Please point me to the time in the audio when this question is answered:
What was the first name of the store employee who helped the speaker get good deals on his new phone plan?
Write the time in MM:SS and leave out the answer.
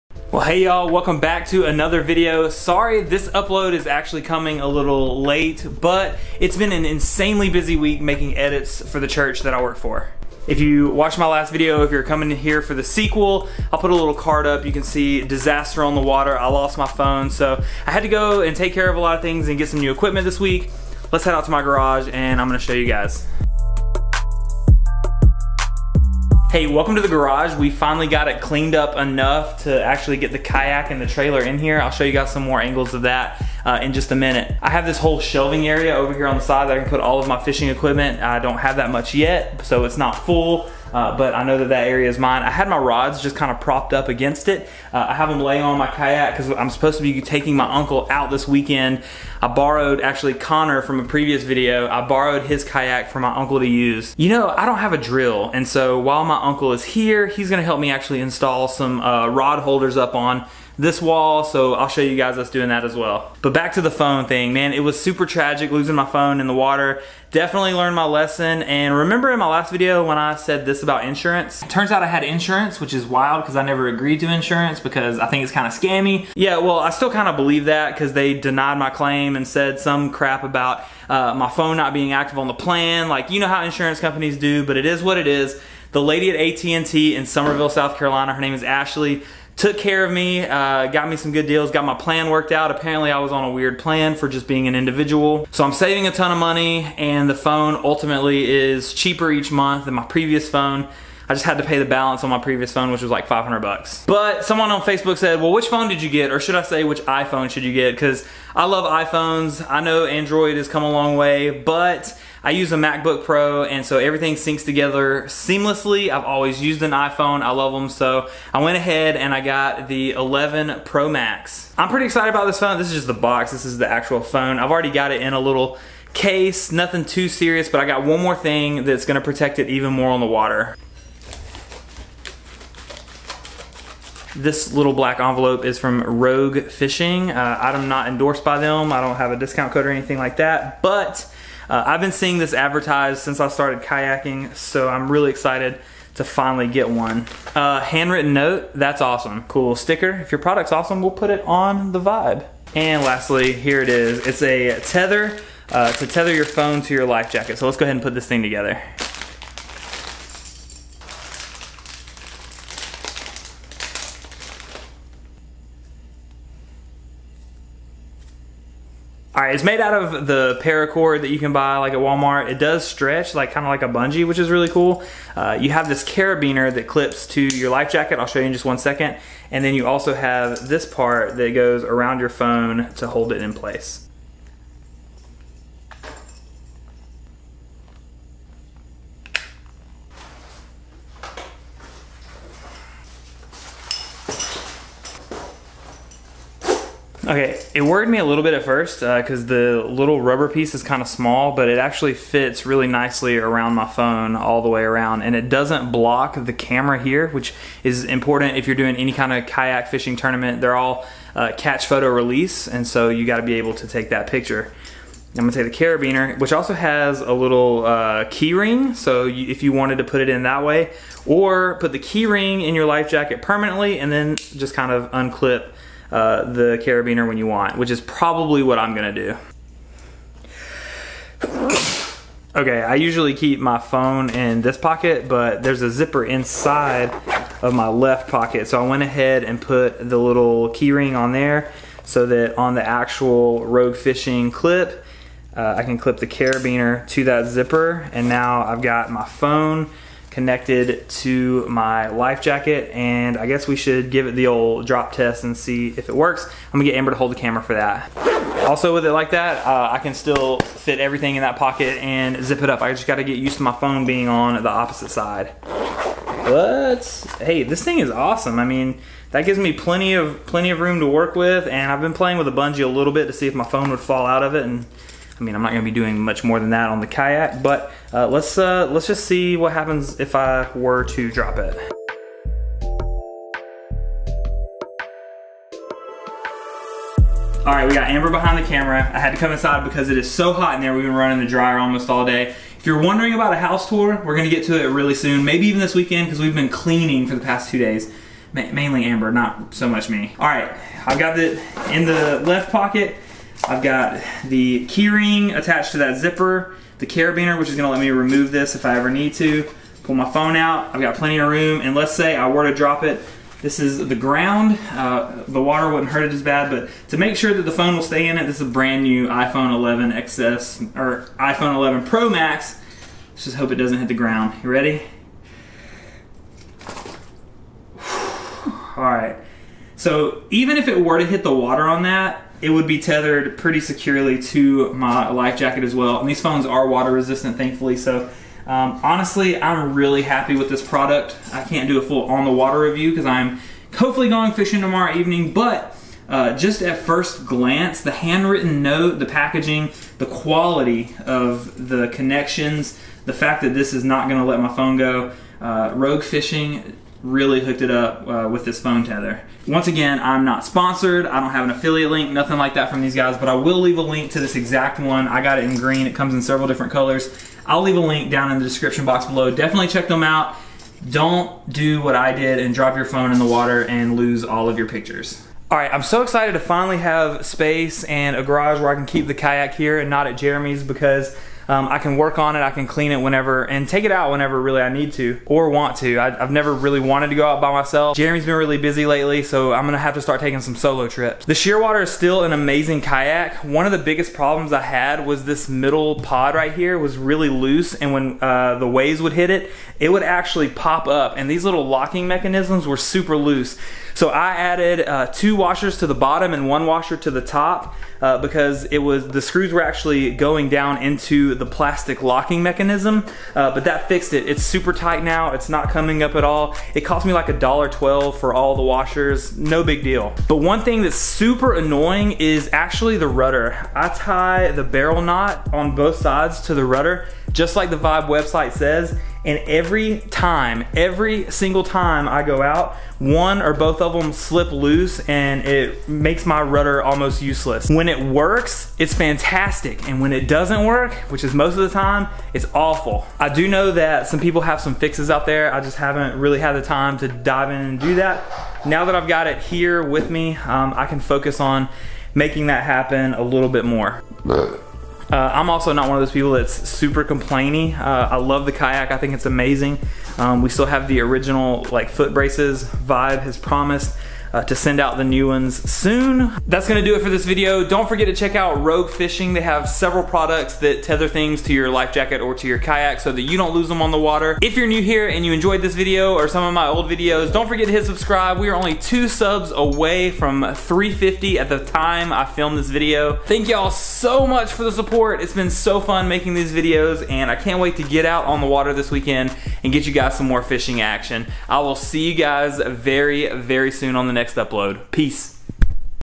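01:28.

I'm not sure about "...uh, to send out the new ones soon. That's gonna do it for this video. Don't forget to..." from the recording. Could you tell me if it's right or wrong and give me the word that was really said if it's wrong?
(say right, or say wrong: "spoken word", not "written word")
right.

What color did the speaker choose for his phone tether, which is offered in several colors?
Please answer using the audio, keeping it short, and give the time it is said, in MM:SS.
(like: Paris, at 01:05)
green, at 06:05.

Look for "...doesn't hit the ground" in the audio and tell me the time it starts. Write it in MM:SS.
05:23.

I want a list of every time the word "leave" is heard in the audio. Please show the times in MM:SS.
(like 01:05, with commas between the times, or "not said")
06:03, 06:07.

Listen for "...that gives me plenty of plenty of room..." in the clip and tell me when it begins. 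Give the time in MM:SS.
04:29.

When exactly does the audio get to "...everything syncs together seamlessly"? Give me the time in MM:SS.
01:53.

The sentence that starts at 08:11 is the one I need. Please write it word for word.
I will see you guys very, very soon on the next upload.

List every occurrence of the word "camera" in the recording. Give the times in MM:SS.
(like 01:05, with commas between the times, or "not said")
03:26, 04:17, 04:48.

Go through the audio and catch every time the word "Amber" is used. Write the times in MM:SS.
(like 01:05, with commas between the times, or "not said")
04:16, 04:48, 04:59.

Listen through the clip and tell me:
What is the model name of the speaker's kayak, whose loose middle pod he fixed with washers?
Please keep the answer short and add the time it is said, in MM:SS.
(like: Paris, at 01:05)
Shearwater, at 06:31.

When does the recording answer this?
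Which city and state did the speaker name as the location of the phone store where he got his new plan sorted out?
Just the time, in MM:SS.
01:27.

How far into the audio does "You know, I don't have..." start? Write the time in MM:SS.
00:54.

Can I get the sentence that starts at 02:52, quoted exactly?
It does stretch, like kind of like a bungee, which is really cool.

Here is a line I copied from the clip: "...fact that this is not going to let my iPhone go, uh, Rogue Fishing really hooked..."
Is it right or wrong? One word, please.
wrong.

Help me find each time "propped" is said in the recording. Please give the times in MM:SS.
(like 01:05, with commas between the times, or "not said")
00:43.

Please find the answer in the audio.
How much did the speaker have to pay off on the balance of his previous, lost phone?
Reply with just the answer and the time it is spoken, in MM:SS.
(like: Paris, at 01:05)
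$500, at 01:43.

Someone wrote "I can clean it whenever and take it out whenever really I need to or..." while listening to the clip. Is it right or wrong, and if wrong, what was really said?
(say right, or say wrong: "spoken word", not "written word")
right.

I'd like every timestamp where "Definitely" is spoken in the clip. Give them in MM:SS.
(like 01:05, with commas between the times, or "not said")
01:07, 06:09.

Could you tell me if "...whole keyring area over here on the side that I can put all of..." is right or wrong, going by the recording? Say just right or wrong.
wrong.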